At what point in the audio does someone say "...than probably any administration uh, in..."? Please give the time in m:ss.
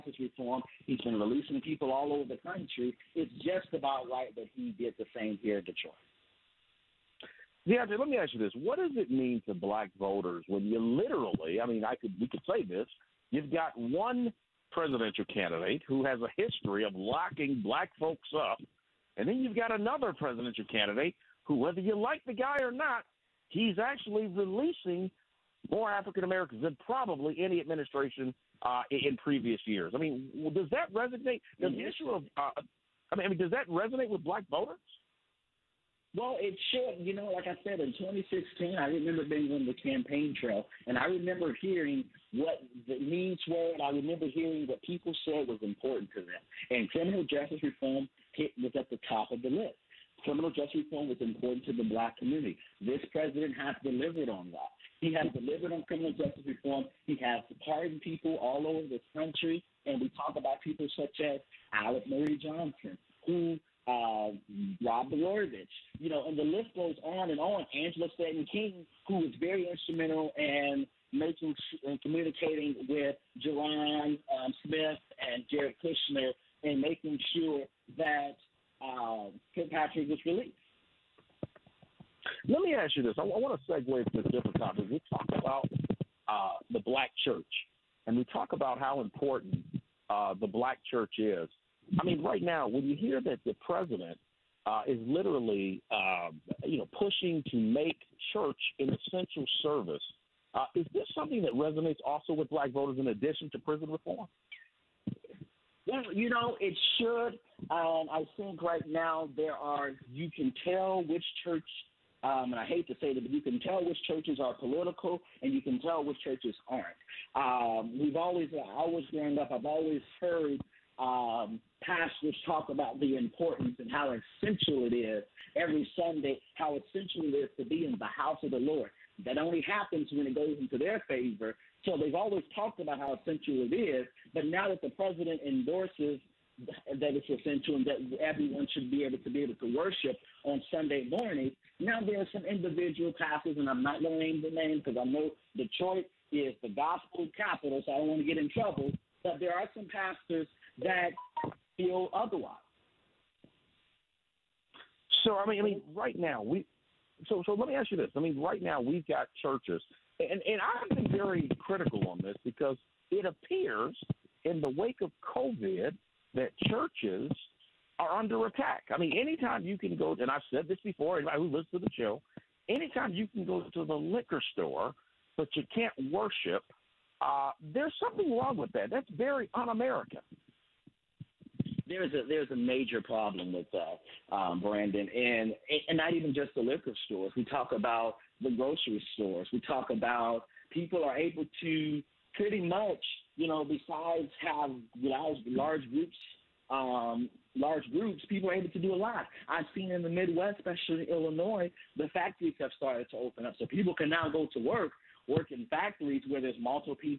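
0:26.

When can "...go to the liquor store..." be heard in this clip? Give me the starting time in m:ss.
2:53.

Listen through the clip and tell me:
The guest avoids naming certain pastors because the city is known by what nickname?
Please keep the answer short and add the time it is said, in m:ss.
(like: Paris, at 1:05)
gospel capital, at 2:26.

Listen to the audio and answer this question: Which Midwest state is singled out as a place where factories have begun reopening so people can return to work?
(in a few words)
Illinois.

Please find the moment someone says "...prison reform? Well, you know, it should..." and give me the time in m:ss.
1:43.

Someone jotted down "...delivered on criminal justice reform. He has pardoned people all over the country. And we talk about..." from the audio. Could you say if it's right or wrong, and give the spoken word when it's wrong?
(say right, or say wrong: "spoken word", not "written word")
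right.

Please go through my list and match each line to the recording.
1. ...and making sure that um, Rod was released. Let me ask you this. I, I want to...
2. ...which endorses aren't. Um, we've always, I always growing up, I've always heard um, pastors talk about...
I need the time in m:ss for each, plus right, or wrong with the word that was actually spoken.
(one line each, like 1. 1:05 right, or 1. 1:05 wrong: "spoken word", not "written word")
1. 1:16 wrong: "Kilpatrick", not "Rod"
2. 1:56 wrong: "churches", not "endorses".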